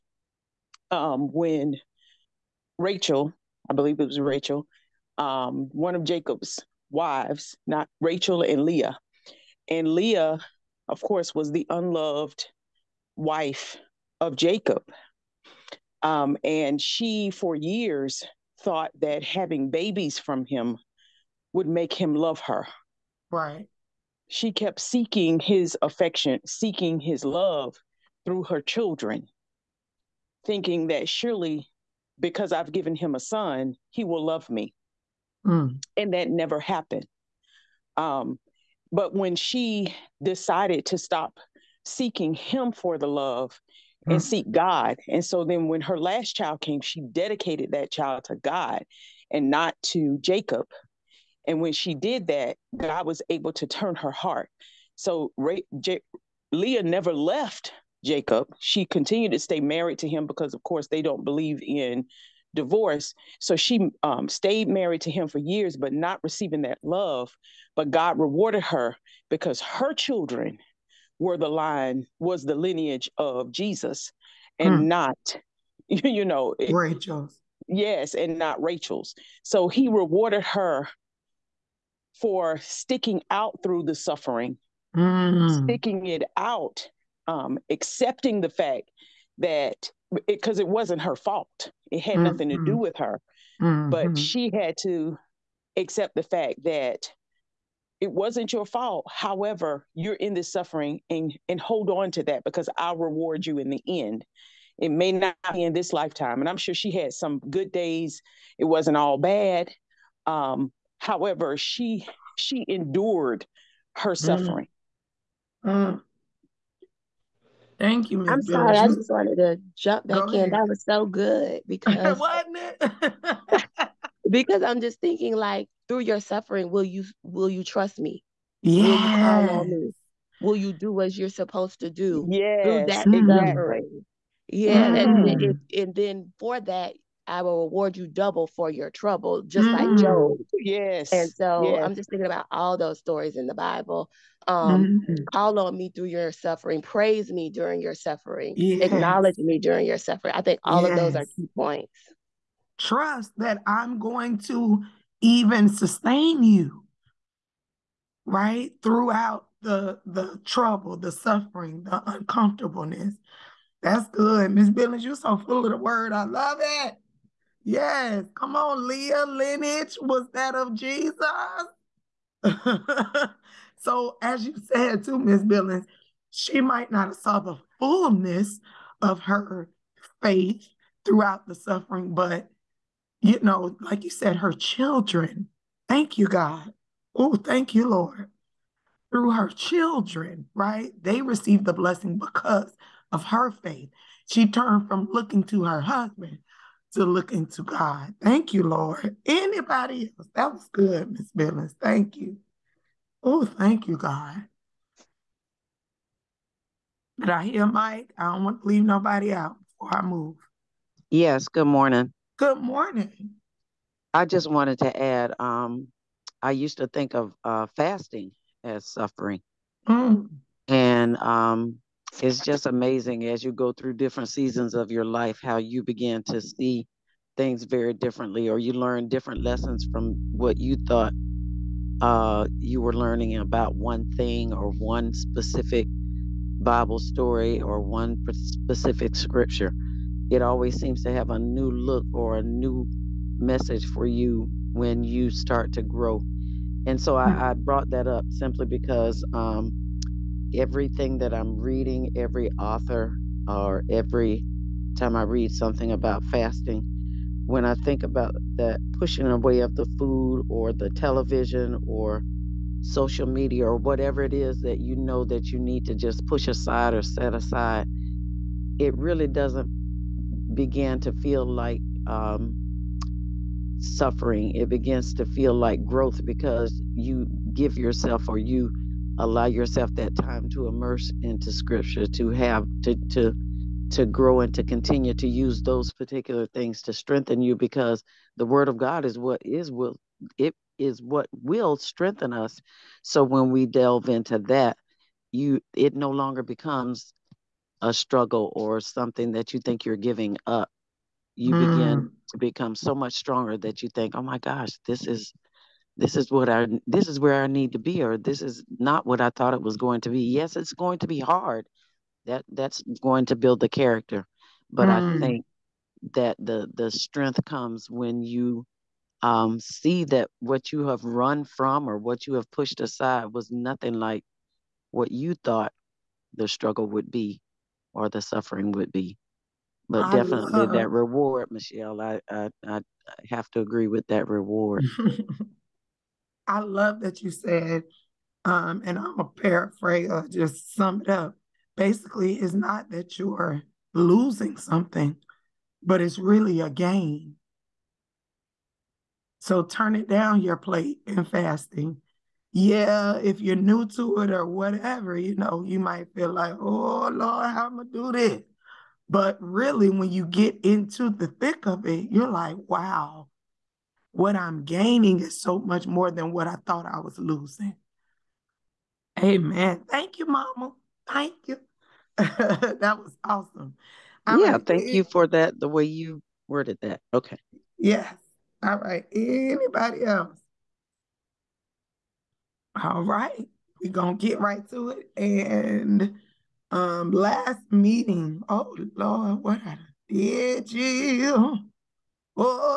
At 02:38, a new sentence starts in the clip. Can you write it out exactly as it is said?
Throughout the the trouble, the suffering, the uncomfortableness.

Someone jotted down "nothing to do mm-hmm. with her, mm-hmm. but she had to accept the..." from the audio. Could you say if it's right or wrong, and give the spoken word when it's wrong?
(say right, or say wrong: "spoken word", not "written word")
right.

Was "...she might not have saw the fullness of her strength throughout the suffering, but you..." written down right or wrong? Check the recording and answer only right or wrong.
wrong.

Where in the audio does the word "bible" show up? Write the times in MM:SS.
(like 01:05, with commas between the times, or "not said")
02:23, 03:56.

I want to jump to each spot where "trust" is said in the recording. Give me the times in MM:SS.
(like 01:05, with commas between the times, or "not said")
02:07, 02:32.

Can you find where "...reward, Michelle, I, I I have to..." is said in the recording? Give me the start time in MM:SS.
05:30.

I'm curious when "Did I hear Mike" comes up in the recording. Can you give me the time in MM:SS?
03:27.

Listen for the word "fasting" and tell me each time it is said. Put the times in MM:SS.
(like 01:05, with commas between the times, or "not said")
03:37, 04:16, 05:51.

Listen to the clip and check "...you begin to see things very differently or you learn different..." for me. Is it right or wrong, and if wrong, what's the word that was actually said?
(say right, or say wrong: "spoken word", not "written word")
right.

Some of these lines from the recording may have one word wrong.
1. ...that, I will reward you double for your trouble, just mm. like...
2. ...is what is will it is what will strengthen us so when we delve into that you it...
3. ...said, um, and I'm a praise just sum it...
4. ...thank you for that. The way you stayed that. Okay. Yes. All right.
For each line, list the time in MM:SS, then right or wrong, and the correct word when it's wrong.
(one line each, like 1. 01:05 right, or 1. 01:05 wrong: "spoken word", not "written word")
1. 02:16 right
2. 04:49 right
3. 05:37 wrong: "paraphrase", not "praise"
4. 06:14 wrong: "worded", not "stayed".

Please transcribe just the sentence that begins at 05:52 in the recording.
Yeah, if you're new to it or whatever, you know, you might feel like, oh Lord, how am I do this?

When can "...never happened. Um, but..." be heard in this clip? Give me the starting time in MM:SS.
00:36.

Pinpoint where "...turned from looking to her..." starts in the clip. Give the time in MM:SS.
03:14.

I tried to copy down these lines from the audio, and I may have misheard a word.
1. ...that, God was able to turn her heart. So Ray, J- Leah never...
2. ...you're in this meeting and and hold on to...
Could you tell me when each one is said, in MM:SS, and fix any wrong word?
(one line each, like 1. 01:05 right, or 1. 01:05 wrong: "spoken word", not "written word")
1. 00:52 right
2. 01:39 wrong: "suffering", not "meeting".